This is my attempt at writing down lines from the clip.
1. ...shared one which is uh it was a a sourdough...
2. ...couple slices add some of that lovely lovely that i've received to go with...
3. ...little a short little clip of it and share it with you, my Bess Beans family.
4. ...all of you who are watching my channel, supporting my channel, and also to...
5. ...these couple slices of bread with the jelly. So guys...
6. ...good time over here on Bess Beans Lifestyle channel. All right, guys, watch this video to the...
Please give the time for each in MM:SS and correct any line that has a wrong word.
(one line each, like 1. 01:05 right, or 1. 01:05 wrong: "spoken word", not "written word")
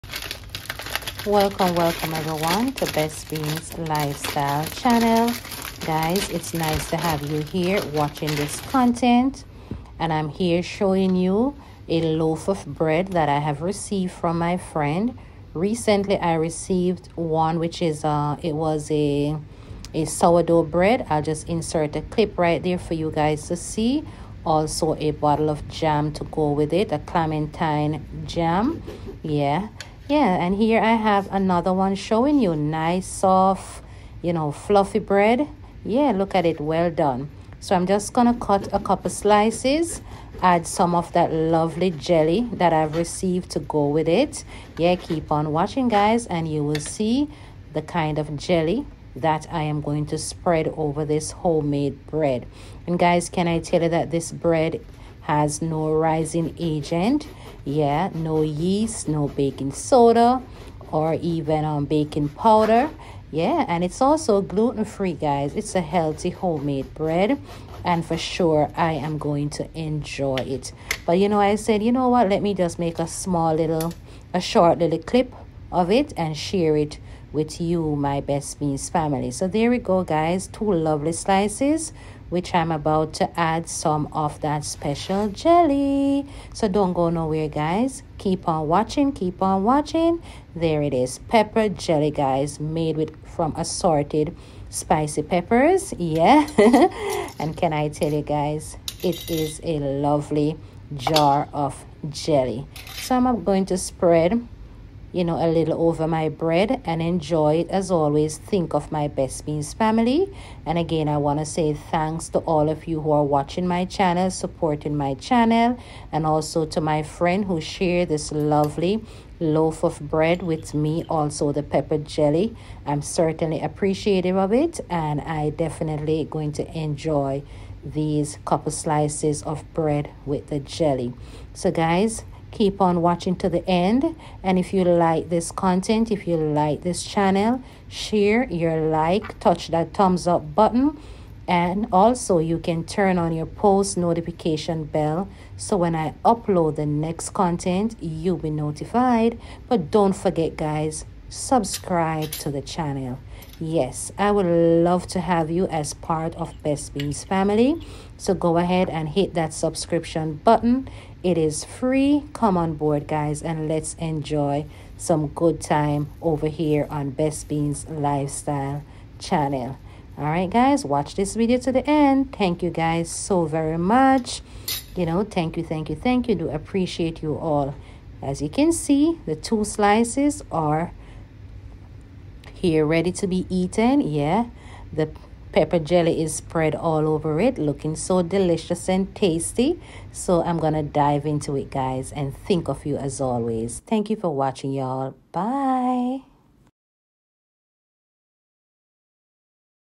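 1. 00:16 wrong: "received", not "shared"
2. 00:38 wrong: "jelly", not "lovely"
3. 01:13 right
4. 01:52 right
5. 02:07 right
6. 02:45 right.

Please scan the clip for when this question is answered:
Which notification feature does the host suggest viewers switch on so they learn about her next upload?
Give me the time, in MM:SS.
02:23.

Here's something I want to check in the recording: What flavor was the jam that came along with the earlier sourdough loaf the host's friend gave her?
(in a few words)
Clementine.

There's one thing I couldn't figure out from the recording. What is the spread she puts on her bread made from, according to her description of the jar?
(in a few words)
Assorted spicy peppers.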